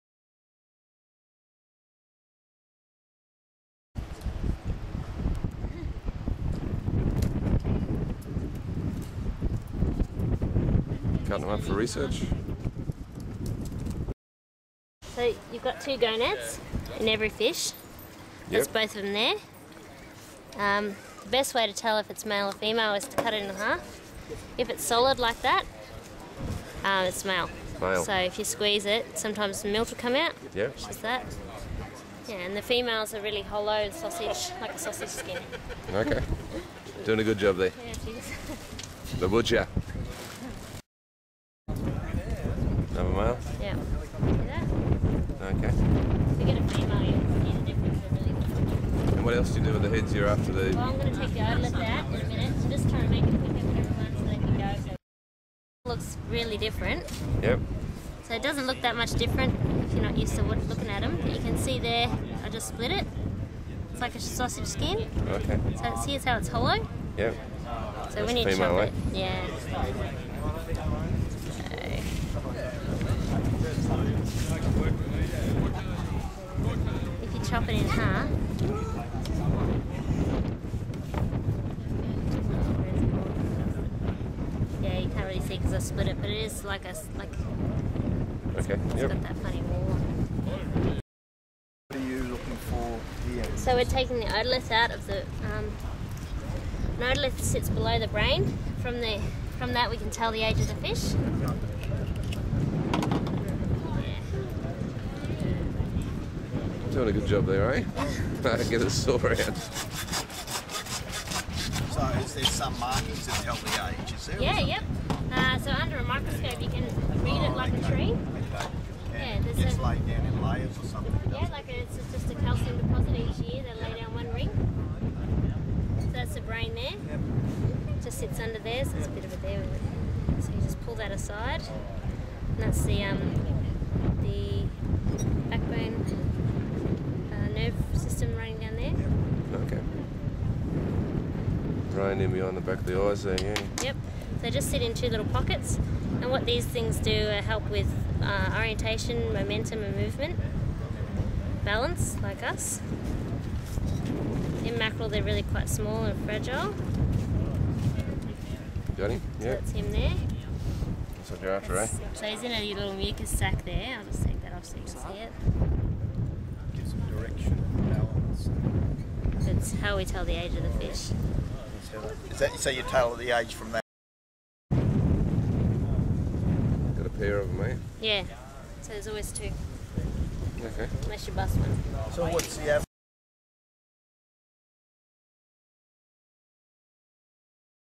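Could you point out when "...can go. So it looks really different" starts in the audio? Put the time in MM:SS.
00:54.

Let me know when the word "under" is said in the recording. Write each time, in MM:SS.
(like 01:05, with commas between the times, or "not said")
01:55, 02:08.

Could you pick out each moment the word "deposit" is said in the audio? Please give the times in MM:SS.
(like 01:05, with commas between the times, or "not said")
02:02.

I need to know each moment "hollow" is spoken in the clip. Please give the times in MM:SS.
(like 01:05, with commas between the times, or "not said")
00:33, 01:06.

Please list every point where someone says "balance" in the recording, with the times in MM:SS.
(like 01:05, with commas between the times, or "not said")
02:31, 02:47.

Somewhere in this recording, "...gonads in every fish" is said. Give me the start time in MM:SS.
00:15.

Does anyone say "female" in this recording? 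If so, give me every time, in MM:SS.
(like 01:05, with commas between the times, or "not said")
00:22, 00:32, 00:46.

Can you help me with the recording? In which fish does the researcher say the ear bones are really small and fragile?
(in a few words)
Mackerel.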